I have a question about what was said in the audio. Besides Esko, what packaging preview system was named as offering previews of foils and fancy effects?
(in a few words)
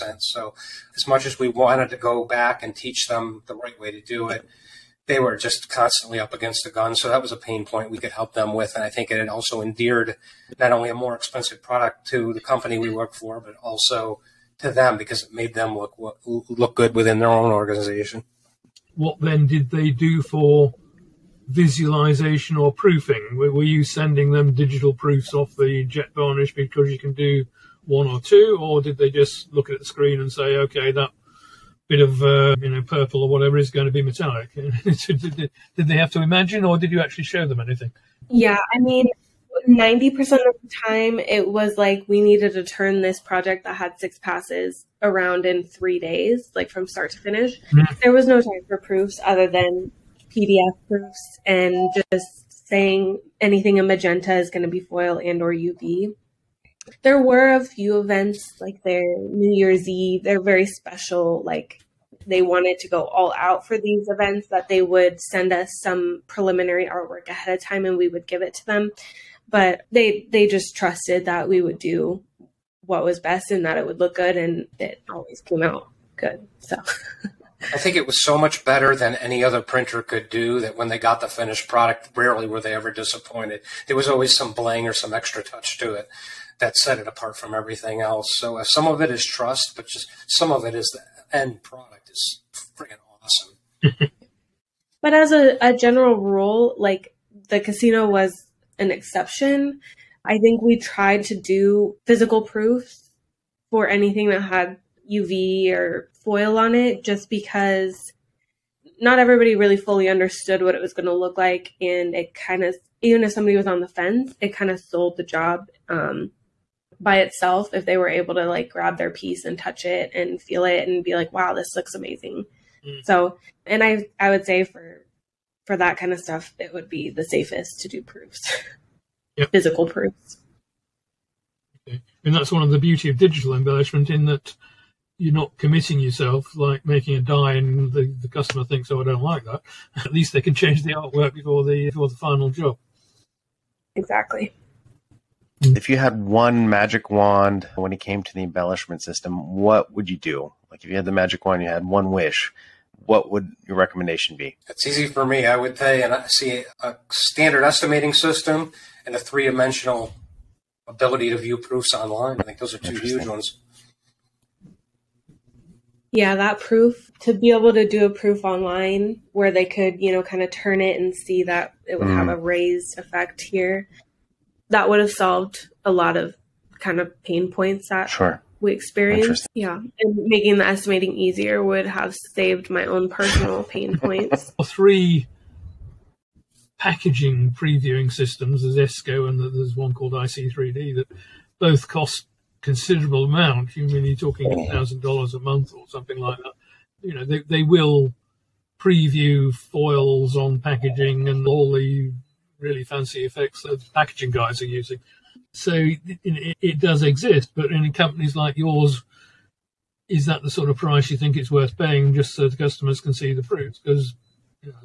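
IC3D.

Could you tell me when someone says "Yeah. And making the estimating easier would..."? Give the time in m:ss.
2:59.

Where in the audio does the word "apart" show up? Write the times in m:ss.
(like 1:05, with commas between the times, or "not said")
1:27.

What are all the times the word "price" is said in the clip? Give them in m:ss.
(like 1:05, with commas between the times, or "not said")
3:30.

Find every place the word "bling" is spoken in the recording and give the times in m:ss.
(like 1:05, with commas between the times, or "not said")
1:24.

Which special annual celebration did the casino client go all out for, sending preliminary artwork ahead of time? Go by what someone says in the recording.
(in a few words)
New Year's Eve.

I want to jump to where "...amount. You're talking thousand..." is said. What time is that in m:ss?
3:13.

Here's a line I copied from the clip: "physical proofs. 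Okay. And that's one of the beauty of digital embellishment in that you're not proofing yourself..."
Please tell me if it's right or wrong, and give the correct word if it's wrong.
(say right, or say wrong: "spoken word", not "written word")
wrong: "committing", not "proofing".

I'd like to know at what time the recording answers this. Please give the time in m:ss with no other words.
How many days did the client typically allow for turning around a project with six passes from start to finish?
0:45.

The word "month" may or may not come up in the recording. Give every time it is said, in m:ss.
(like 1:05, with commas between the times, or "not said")
3:15.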